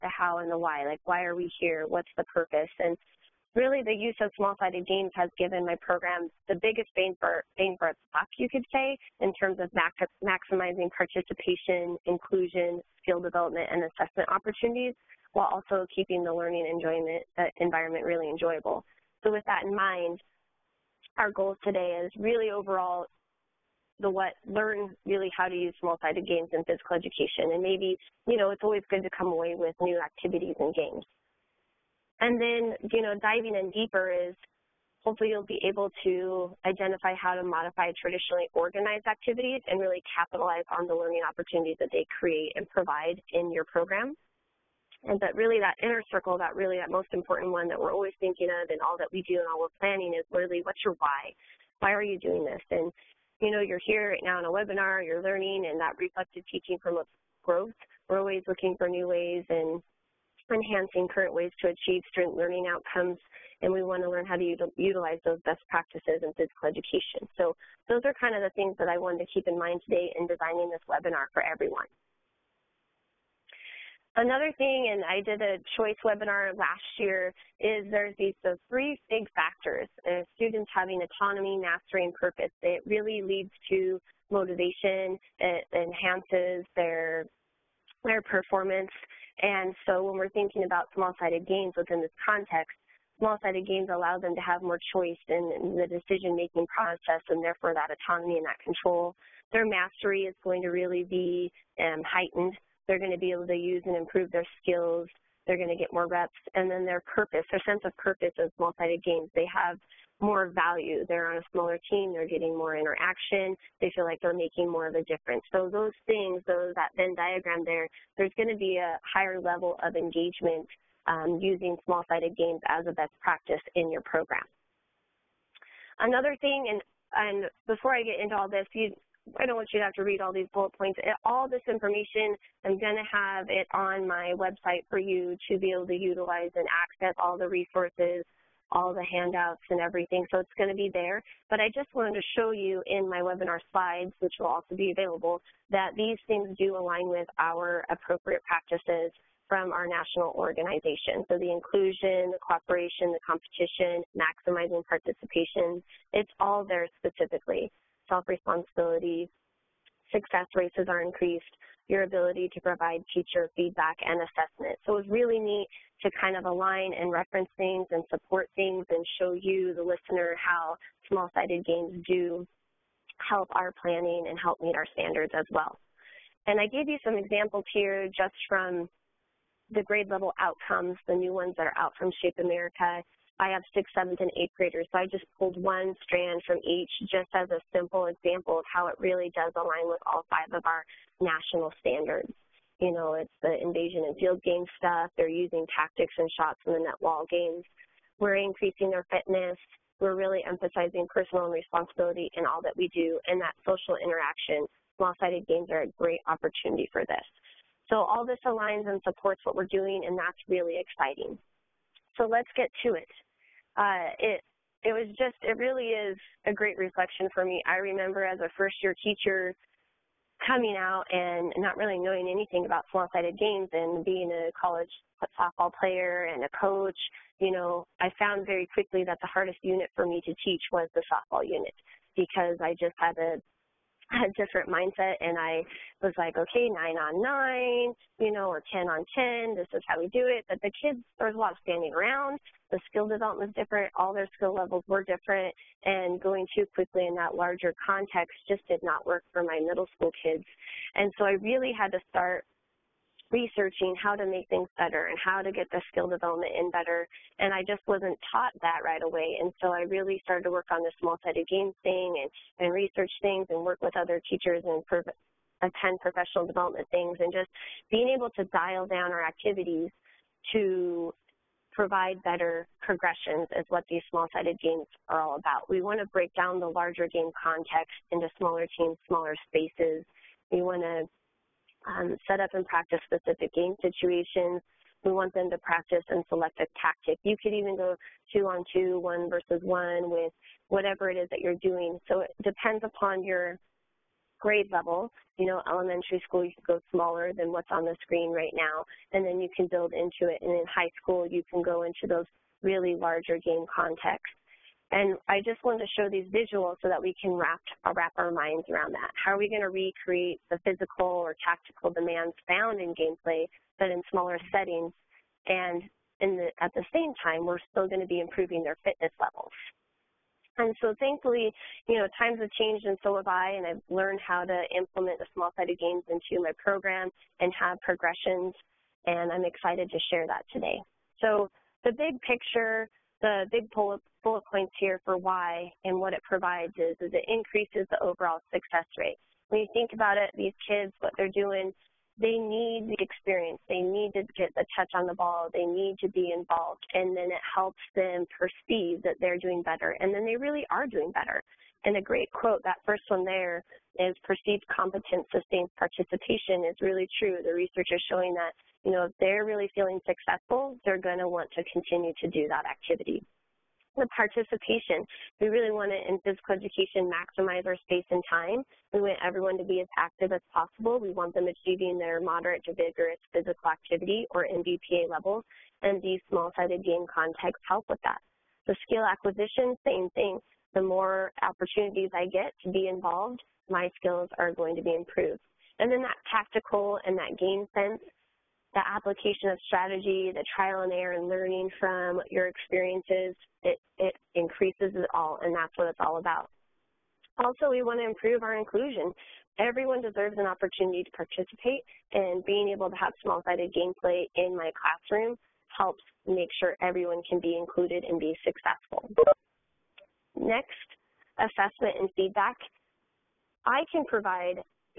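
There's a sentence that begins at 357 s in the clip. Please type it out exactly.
The research is showing that, you know, if they're really feeling successful, they're going to want to continue to do that activity.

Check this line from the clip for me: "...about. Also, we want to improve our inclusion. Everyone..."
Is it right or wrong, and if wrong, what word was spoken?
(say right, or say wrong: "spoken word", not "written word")
right.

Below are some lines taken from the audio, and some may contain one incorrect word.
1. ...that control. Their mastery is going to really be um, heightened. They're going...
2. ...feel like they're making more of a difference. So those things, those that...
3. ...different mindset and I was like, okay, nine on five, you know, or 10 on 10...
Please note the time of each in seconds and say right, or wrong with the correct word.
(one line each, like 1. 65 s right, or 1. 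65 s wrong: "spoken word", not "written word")
1. 98 s right
2. 113 s right
3. 234 s wrong: "nine", not "five".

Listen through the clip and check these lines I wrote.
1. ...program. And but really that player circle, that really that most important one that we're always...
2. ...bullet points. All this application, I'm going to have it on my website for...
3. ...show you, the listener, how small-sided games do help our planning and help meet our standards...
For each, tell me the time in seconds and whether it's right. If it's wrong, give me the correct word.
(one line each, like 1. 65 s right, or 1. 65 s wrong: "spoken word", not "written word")
1. 43 s wrong: "inner", not "player"
2. 130 s wrong: "information", not "application"
3. 169 s right.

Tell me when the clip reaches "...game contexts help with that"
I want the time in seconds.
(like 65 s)
376 s.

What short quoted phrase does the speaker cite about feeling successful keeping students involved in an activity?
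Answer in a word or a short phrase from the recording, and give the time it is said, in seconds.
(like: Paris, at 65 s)
perceived competence sustains participation, at 354 s.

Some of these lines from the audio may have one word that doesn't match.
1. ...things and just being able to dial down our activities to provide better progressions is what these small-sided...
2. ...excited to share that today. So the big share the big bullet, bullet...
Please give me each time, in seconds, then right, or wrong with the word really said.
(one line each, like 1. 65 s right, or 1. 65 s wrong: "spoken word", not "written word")
1. 266 s right
2. 329 s wrong: "picture", not "share".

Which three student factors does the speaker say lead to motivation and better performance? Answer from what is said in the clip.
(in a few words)
autonomy, mastery, and purpose.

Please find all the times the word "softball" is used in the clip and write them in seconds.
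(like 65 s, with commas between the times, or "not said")
225 s, 231 s.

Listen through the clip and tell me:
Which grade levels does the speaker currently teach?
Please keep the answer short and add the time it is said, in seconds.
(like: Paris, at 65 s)
sixth, seventh, and eighth, at 183 s.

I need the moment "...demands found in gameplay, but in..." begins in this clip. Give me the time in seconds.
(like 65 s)
311 s.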